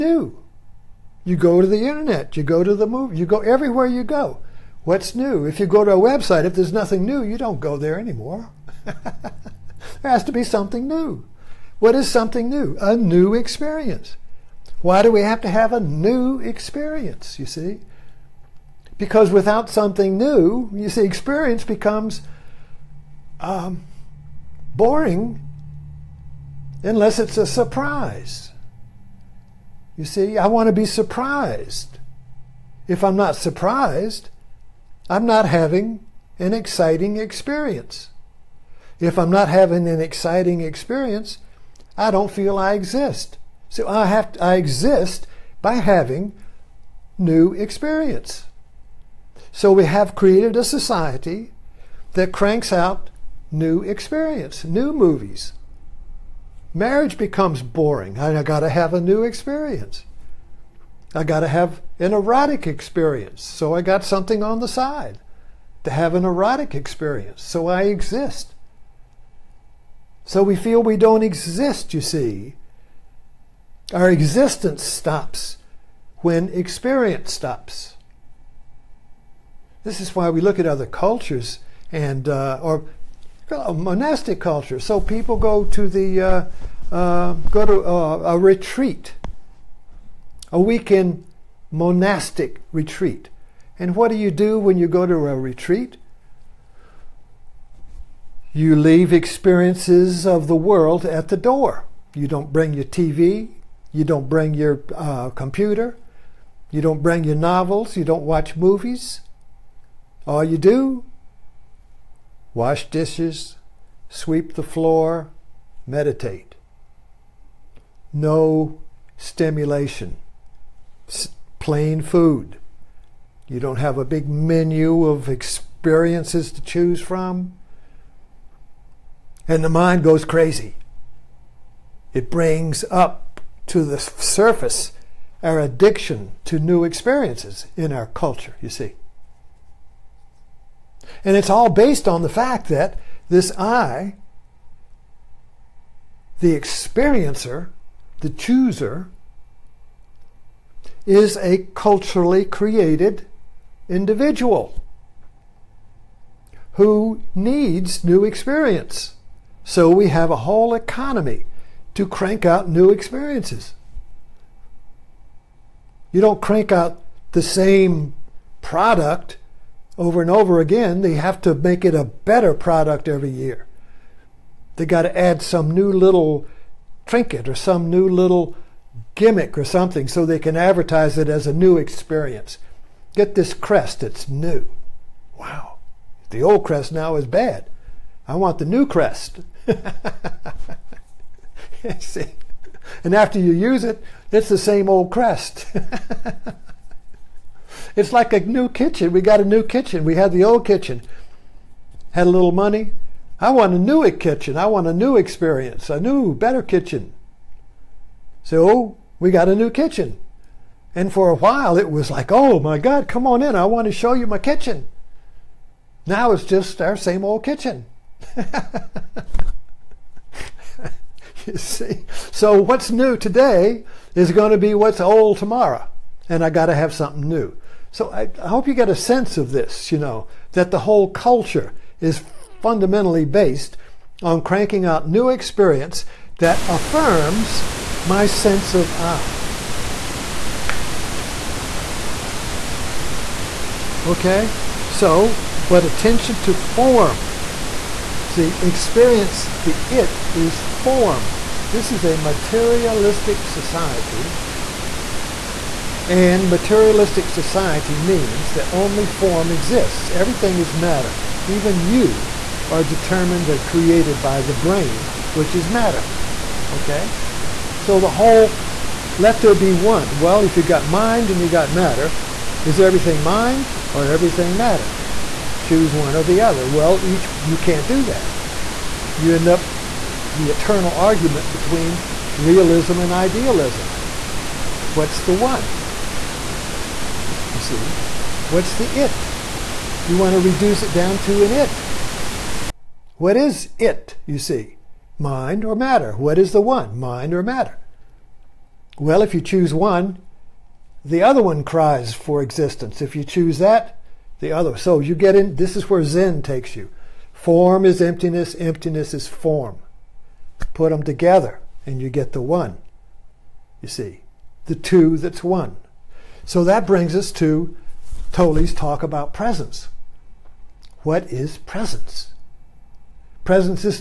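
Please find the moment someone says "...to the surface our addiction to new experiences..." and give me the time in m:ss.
2:13.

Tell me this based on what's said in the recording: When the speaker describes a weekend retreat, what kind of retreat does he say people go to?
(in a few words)
Monastic retreat.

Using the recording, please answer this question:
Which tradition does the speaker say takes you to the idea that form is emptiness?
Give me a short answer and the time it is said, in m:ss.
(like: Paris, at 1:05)
Zen, at 5:06.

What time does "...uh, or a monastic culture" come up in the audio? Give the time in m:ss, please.
1:22.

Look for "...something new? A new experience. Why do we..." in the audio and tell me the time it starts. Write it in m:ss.
0:12.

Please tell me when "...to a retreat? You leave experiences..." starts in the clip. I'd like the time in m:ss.
1:35.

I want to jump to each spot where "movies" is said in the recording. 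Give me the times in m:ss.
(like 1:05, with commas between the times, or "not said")
0:02, 0:54, 1:48.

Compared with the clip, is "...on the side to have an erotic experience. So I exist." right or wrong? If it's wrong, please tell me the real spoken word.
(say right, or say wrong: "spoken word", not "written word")
right.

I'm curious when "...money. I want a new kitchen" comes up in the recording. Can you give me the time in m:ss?
3:22.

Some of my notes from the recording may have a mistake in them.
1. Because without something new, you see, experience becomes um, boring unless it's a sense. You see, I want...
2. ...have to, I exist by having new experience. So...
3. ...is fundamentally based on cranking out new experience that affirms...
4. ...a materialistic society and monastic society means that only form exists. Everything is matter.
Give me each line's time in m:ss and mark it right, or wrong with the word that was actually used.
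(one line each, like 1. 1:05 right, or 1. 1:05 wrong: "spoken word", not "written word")
1. 0:18 wrong: "surprise", not "sense"
2. 0:44 right
3. 3:51 right
4. 4:12 wrong: "materialistic", not "monastic".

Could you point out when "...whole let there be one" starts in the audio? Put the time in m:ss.
4:28.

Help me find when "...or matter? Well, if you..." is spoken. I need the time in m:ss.
4:57.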